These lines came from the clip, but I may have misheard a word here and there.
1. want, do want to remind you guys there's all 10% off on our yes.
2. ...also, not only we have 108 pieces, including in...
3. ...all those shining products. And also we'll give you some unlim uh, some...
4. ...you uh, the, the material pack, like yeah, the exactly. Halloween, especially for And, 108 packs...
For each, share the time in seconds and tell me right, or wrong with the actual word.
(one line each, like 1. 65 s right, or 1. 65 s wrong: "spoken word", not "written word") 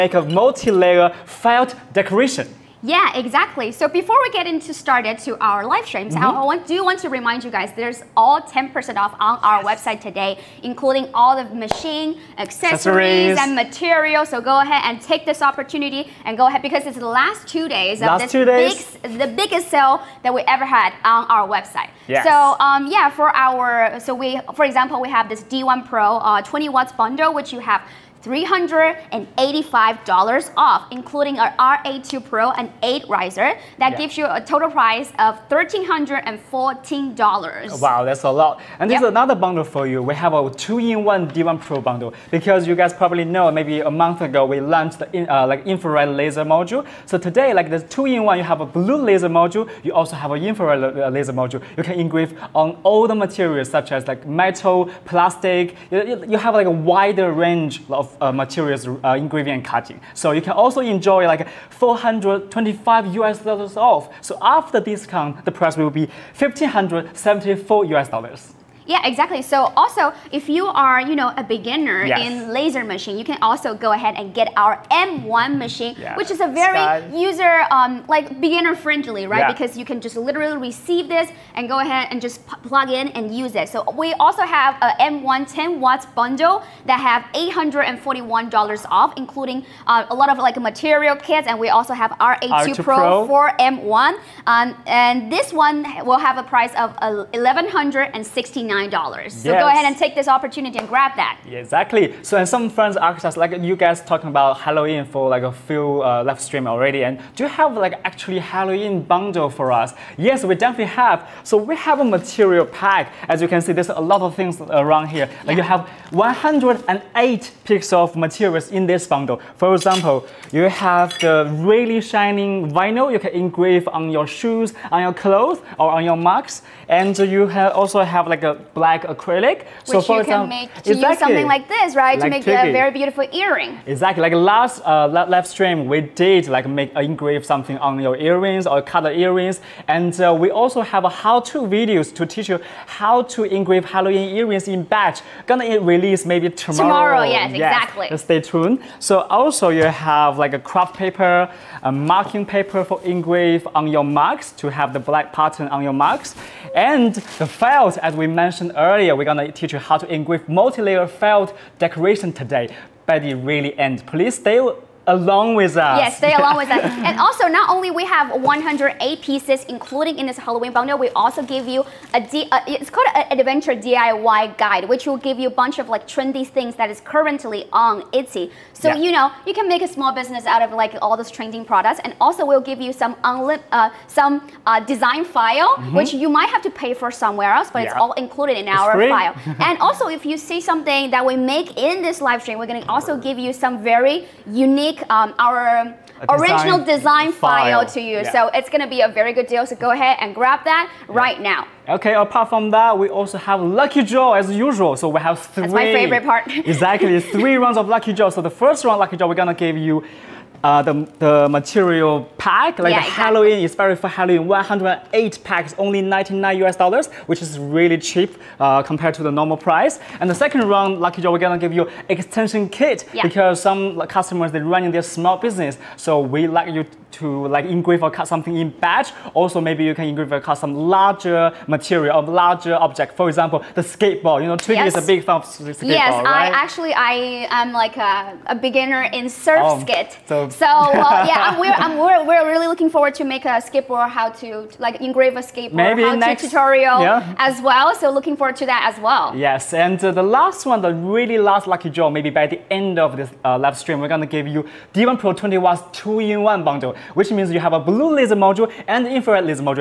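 1. 6 s right
2. 167 s right
3. 181 s wrong: "trending", not "shining"
4. 209 s wrong: "Halloween", not "And".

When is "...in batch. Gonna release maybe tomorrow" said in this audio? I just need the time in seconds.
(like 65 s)
144 s.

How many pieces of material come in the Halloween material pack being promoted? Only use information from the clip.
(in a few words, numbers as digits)
108.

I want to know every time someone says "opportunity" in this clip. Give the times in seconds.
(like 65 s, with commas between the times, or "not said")
15 s, 100 s.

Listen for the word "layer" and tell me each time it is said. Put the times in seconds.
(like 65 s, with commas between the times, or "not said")
0 s, 160 s.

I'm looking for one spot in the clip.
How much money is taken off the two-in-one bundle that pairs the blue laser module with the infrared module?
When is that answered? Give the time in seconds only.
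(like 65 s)
61 s.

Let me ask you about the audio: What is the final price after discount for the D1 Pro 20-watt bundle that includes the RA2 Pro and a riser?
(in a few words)
$1,314.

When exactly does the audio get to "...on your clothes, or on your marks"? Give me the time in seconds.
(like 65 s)
124 s.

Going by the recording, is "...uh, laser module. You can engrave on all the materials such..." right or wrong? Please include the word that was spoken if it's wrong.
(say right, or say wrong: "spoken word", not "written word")
right.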